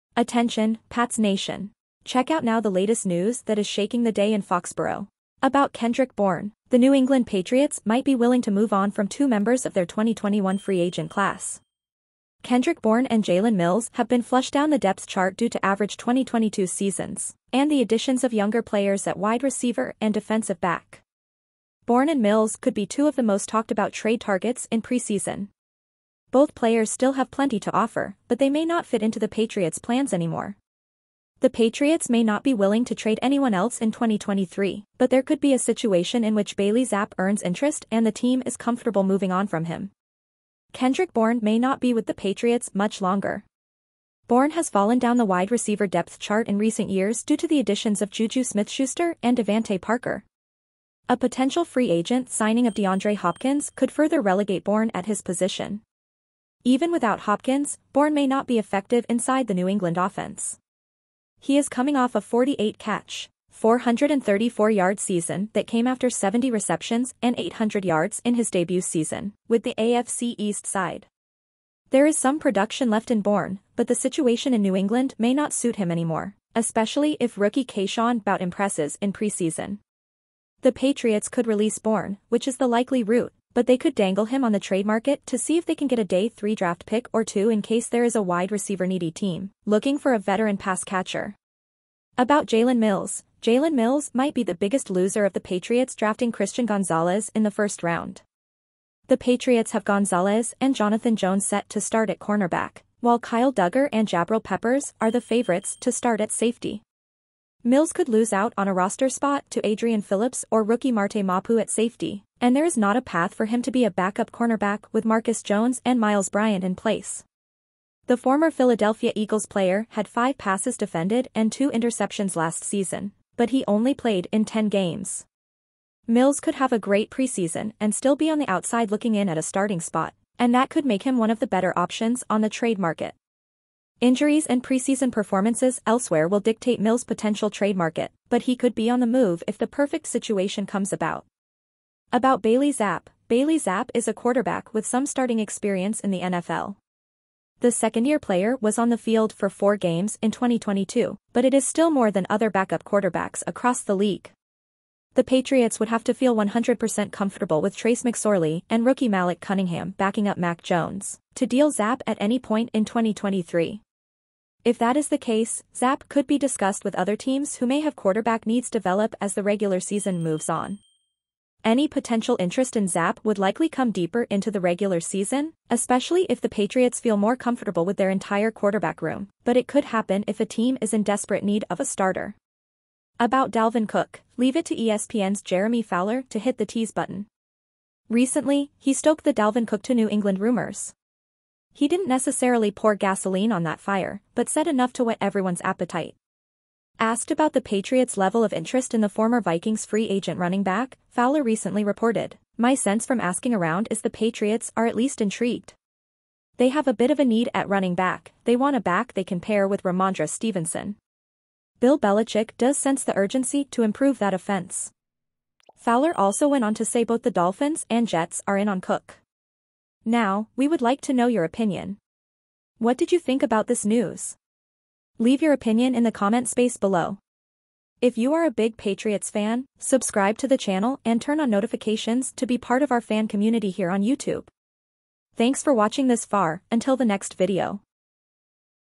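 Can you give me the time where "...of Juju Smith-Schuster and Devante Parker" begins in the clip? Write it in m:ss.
0:48.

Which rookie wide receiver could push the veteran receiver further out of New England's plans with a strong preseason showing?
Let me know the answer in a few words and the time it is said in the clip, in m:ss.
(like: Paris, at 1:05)
Kayshon Boutte, at 1:17.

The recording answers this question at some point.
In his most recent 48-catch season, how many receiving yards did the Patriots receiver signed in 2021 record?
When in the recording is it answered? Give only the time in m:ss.
1:03.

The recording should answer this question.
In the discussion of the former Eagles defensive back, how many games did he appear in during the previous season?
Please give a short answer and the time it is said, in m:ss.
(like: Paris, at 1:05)
10, at 2:04.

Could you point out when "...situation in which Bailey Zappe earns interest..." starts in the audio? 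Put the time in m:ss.
0:35.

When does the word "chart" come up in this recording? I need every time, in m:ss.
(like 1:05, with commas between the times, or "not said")
0:15, 0:46.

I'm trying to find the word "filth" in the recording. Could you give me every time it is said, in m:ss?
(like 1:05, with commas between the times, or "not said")
not said.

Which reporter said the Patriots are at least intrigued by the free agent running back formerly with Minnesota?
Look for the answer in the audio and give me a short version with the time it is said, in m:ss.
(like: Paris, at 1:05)
Jeremy Fowler, at 3:05.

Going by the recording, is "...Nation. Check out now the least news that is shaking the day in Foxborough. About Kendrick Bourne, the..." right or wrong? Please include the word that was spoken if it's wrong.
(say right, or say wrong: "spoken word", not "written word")
wrong: "latest", not "least".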